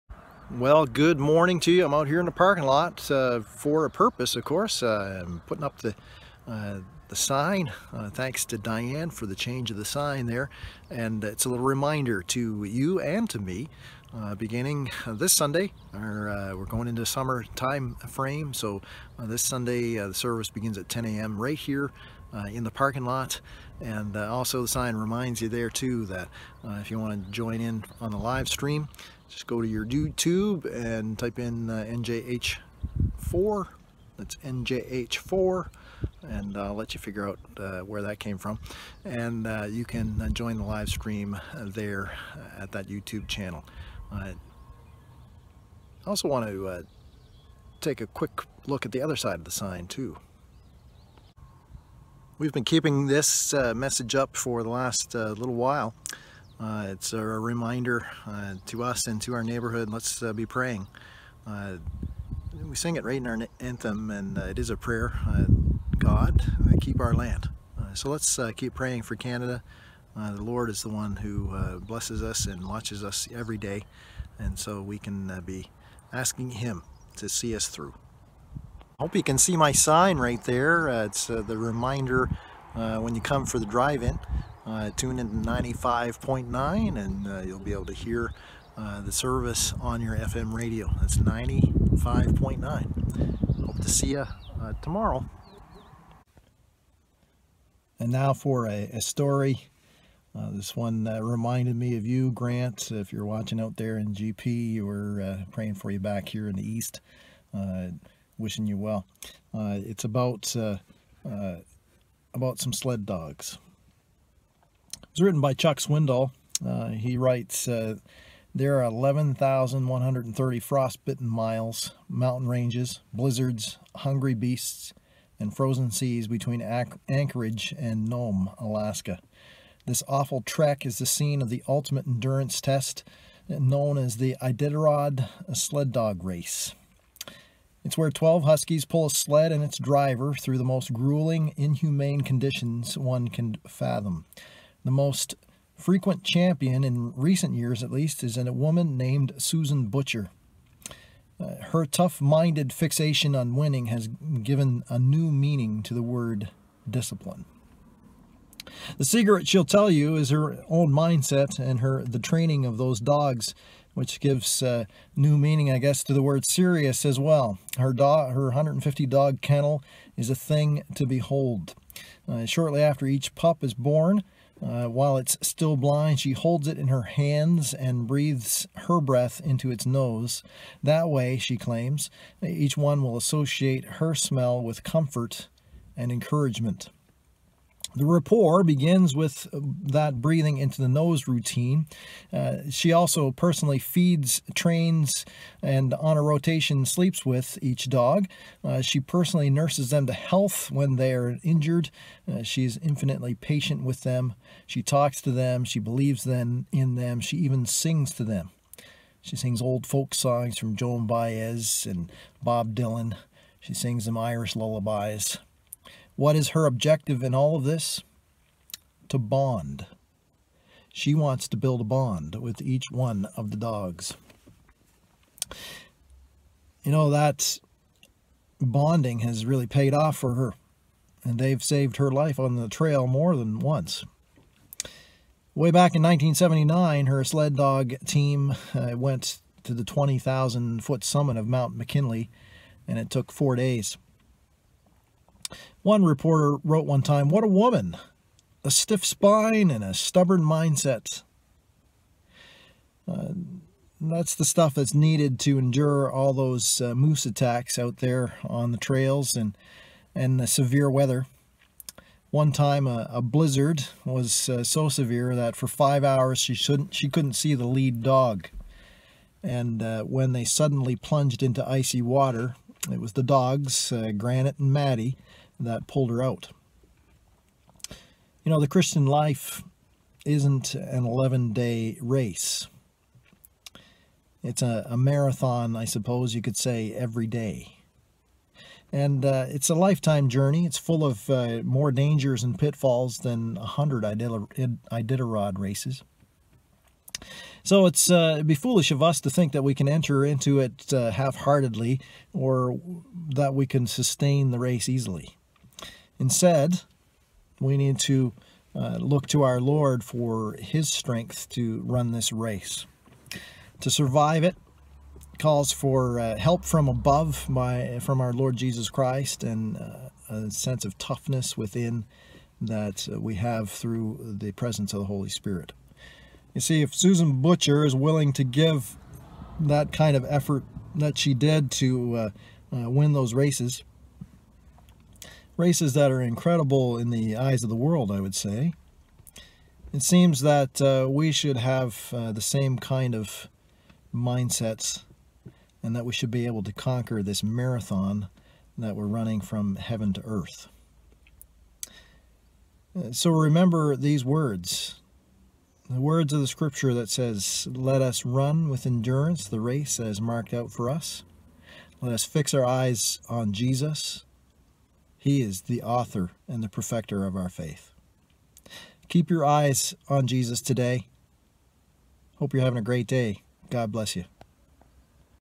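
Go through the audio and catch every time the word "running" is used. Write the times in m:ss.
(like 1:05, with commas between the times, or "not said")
5:49.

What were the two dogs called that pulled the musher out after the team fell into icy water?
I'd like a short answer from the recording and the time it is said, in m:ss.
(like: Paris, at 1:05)
Granite and Maddie, at 4:34.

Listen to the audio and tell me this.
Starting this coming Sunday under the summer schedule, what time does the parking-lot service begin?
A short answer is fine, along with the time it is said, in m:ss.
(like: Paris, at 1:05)
10 a.m., at 0:20.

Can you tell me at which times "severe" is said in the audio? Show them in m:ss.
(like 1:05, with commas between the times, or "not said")
4:20, 4:24.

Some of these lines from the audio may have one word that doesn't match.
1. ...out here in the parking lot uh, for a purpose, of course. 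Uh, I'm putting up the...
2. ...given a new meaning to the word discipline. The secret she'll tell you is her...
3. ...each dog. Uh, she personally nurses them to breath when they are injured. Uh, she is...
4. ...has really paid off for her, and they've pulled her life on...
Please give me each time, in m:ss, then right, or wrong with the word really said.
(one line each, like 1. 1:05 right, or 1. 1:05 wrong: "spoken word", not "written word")
1. 0:01 right
2. 2:34 right
3. 3:17 wrong: "health", not "breath"
4. 3:49 wrong: "saved", not "pulled".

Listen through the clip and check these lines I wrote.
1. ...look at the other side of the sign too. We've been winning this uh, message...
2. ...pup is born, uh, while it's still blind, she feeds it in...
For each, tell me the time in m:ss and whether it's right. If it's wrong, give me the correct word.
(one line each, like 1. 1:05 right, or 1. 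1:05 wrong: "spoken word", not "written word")
1. 0:48 wrong: "keeping", not "winning"
2. 2:53 wrong: "holds", not "feeds".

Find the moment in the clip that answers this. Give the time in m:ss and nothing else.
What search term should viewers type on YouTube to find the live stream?
0:31.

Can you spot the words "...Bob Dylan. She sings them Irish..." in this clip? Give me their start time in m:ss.
3:32.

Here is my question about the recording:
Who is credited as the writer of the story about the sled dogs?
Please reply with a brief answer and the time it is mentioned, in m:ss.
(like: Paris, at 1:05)
Chuck Swindoll, at 1:55.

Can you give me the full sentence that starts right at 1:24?
Uh, tune to 95.9 and uh, you'll be able to hear uh, the service on your FM radio.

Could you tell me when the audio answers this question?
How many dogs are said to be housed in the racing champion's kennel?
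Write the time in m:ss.
2:48.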